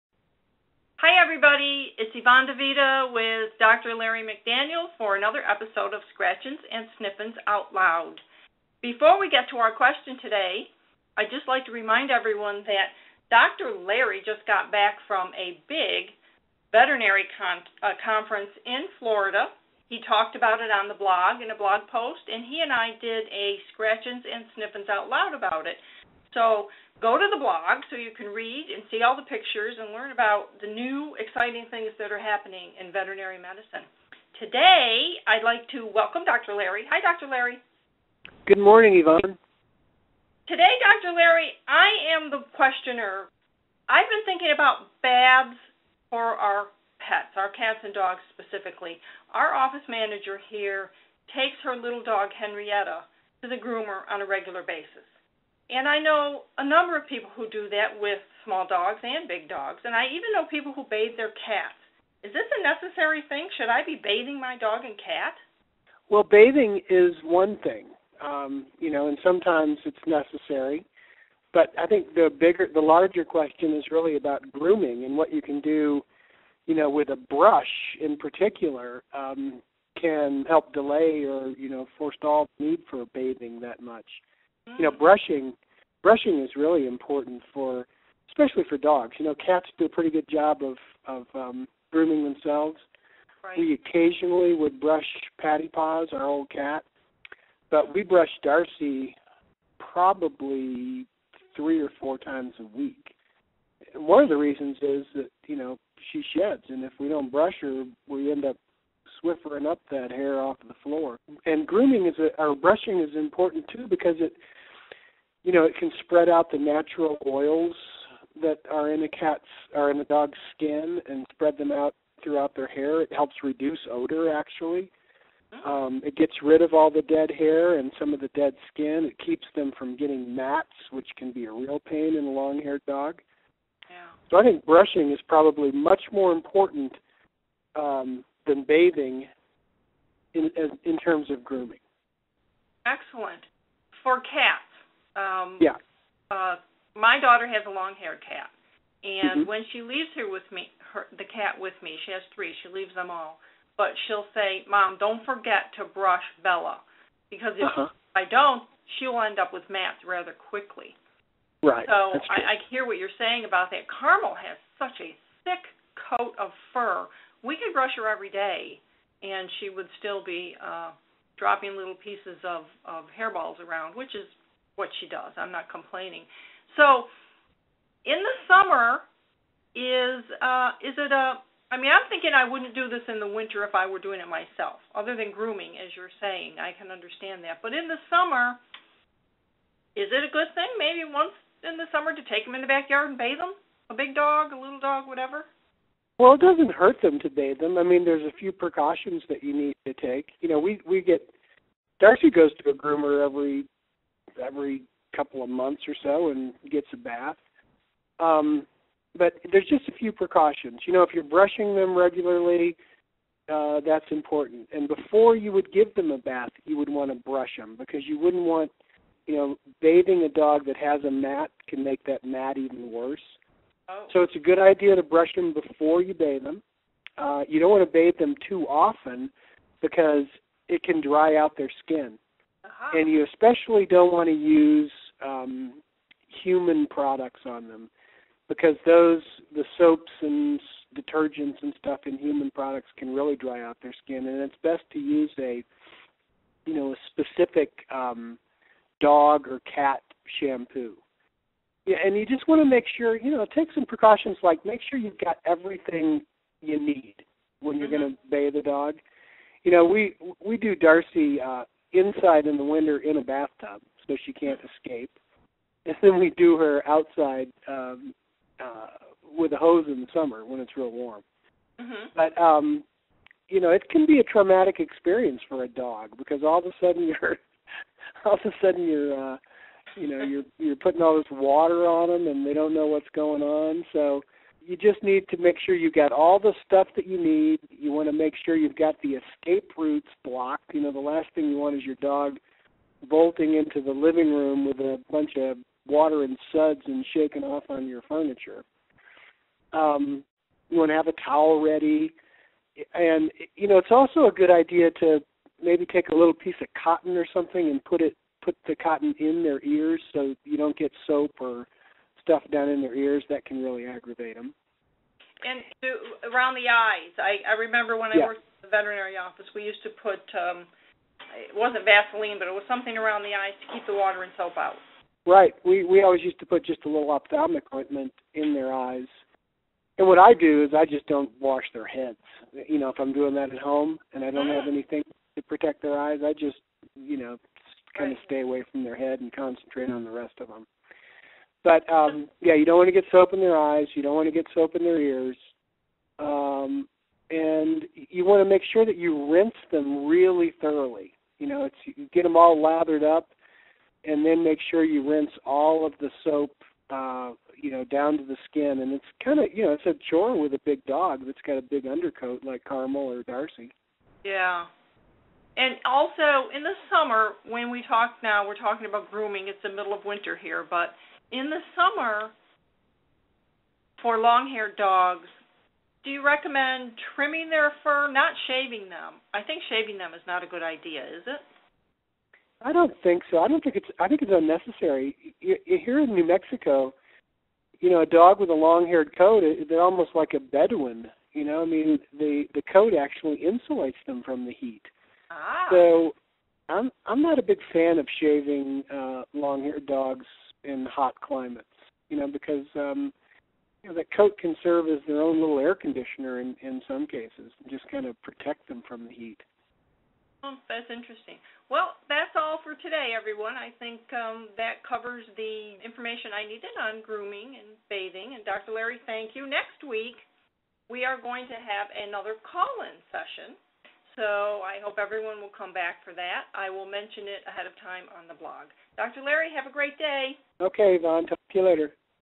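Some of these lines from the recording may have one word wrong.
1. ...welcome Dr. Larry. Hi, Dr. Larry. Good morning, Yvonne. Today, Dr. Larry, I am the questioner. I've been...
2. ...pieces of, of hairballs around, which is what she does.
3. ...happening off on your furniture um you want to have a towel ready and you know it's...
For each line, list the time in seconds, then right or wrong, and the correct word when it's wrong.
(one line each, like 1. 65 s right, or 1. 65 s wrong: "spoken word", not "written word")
1. 35 s right
2. 171 s right
3. 297 s wrong: "shaking", not "happening".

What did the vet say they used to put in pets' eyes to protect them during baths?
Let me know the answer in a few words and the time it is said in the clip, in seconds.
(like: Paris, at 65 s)
ophthalmic ointment, at 327 s.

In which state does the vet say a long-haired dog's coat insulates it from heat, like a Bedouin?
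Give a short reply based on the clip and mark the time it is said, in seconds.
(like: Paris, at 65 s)
New Mexico, at 386 s.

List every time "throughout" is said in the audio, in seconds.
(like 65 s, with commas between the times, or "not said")
122 s.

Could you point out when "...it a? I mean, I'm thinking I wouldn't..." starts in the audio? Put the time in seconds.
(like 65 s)
180 s.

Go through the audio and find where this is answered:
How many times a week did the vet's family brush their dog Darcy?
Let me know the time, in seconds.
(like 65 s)
101 s.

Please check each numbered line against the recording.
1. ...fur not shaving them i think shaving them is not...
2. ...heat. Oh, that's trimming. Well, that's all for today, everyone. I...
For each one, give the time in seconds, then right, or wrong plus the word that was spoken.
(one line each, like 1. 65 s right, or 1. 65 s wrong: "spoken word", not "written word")
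1. 377 s right
2. 409 s wrong: "interesting", not "trimming".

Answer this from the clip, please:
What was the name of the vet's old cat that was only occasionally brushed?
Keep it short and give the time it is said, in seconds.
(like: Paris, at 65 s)
Patty Paws, at 95 s.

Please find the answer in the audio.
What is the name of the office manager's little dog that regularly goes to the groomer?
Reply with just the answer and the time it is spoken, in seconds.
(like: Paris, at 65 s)
Henrietta, at 52 s.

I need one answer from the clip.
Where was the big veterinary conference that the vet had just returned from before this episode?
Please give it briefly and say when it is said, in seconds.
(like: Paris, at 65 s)
Florida, at 19 s.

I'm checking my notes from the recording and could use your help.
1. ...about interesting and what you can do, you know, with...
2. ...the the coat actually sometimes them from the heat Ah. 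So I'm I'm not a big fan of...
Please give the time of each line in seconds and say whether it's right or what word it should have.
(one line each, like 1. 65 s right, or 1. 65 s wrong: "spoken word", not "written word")
1. 74 s wrong: "grooming", not "interesting"
2. 392 s wrong: "insulates", not "sometimes".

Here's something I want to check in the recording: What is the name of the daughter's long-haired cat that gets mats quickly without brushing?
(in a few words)
Bella.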